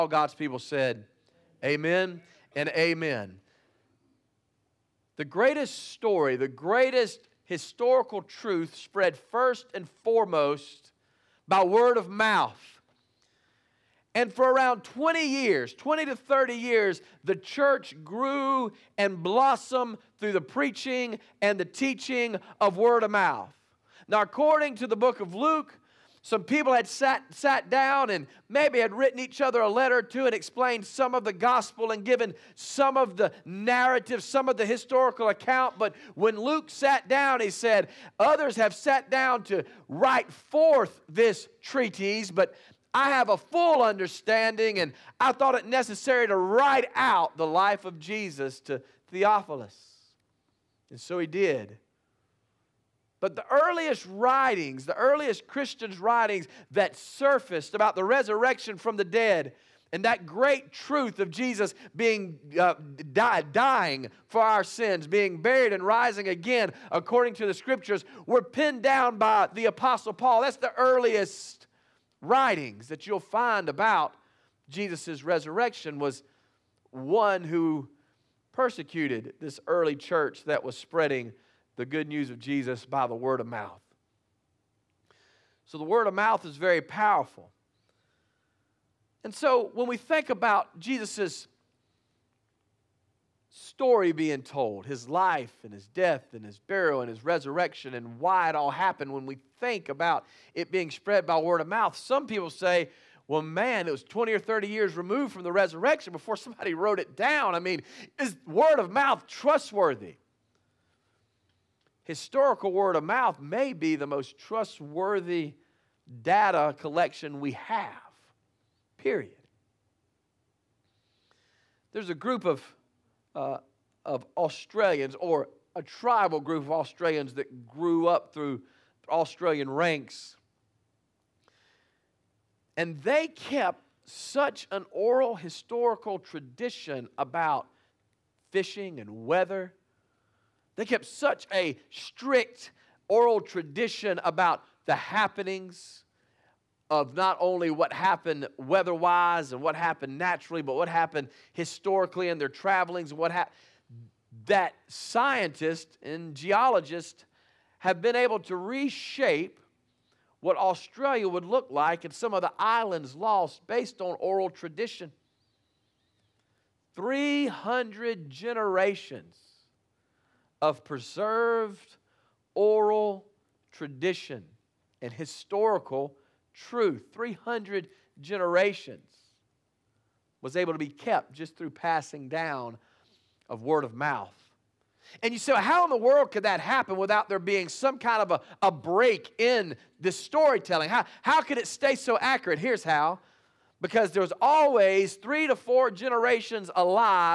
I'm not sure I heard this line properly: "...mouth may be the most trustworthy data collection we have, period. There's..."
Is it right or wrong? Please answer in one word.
right.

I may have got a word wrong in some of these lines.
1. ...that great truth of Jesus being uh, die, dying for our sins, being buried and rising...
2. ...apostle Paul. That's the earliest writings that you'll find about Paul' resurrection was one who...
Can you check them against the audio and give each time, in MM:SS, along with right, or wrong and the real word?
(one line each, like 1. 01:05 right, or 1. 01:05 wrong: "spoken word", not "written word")
1. 01:00 right
2. 01:09 wrong: "Jesus", not "Paul".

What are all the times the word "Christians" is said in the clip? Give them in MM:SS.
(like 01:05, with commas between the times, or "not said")
00:55.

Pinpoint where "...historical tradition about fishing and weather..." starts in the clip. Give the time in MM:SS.
02:15.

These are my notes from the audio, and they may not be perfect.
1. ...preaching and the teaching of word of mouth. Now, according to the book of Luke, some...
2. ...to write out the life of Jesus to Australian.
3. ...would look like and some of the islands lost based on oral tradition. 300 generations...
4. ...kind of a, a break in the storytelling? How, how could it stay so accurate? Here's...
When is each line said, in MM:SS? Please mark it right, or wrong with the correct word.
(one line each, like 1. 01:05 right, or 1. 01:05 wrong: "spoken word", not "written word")
1. 00:20 right
2. 00:46 wrong: "Theophilus", not "Australian"
3. 02:41 right
4. 03:07 right.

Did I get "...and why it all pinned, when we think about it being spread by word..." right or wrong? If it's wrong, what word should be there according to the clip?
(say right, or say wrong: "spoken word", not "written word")
wrong: "happened", not "pinned".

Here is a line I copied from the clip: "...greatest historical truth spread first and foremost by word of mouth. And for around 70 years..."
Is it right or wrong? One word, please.
wrong.